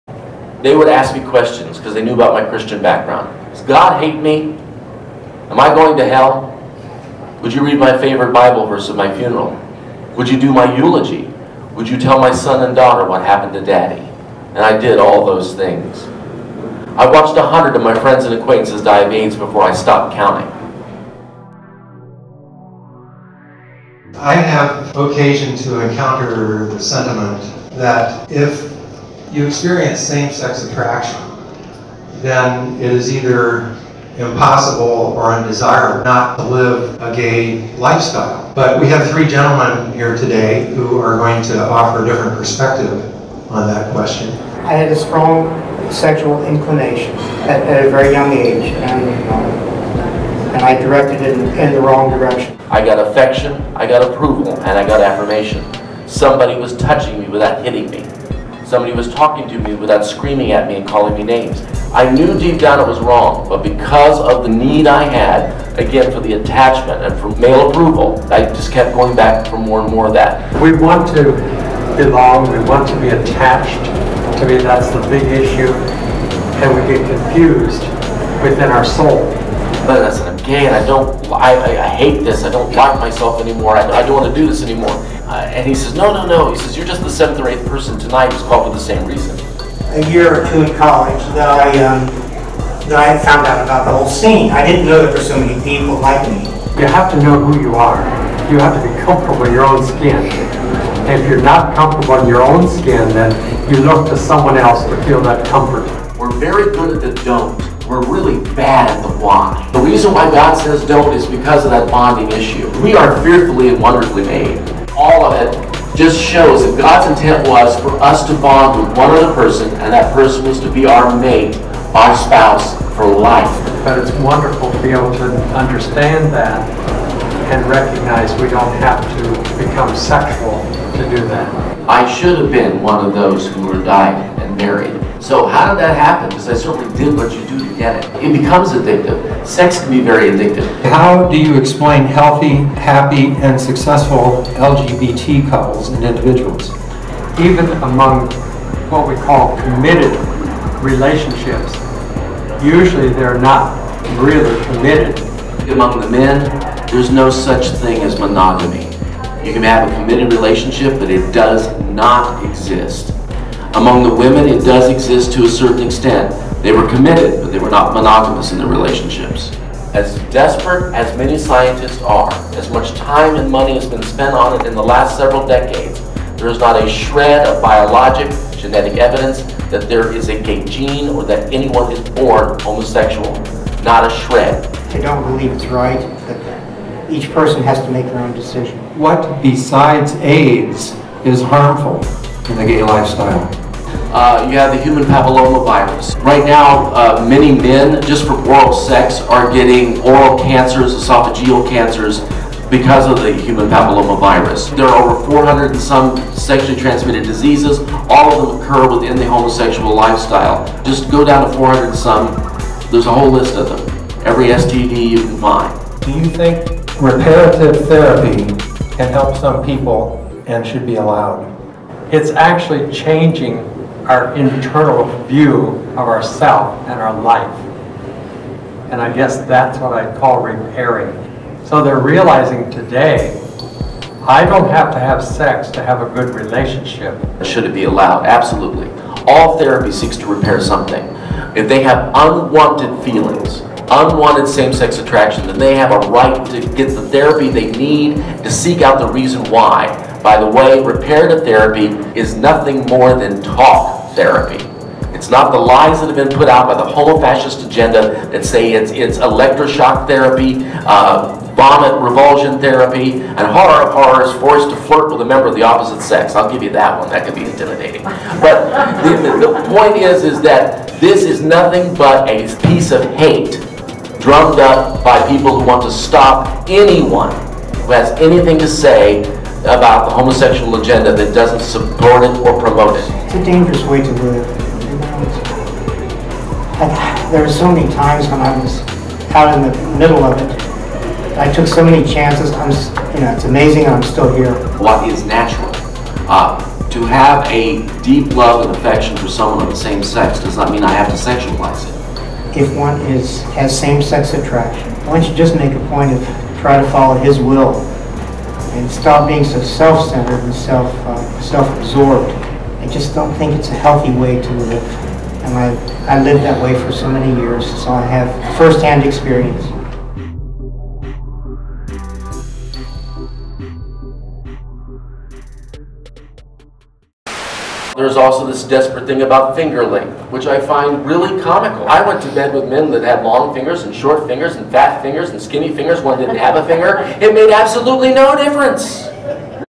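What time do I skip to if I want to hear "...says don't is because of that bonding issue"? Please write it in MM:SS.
01:50.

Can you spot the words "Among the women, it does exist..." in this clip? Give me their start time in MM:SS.
02:43.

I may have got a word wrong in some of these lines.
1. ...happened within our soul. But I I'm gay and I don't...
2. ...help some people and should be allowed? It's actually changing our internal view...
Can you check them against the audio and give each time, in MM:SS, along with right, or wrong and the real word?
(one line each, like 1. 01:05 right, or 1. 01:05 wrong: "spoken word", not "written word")
1. 01:17 wrong: "confused", not "happened"
2. 03:39 right.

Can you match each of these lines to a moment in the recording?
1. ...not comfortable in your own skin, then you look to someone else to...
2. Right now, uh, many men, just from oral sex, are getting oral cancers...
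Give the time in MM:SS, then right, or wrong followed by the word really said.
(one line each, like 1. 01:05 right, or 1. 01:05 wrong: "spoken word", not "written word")
1. 01:41 right
2. 03:16 right.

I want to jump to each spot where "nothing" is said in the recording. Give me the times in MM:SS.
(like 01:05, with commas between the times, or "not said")
04:12, 04:31.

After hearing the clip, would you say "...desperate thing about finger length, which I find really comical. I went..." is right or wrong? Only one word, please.
right.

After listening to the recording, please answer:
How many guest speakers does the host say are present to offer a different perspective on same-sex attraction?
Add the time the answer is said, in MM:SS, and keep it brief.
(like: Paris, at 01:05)
3, at 00:39.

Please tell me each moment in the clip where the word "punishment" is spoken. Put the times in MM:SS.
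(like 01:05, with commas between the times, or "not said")
not said.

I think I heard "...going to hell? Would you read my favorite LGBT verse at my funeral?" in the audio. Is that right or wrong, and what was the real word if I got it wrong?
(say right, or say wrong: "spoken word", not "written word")
wrong: "Bible", not "LGBT".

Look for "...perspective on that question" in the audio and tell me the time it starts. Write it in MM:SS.
00:42.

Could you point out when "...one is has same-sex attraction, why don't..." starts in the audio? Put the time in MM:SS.
05:02.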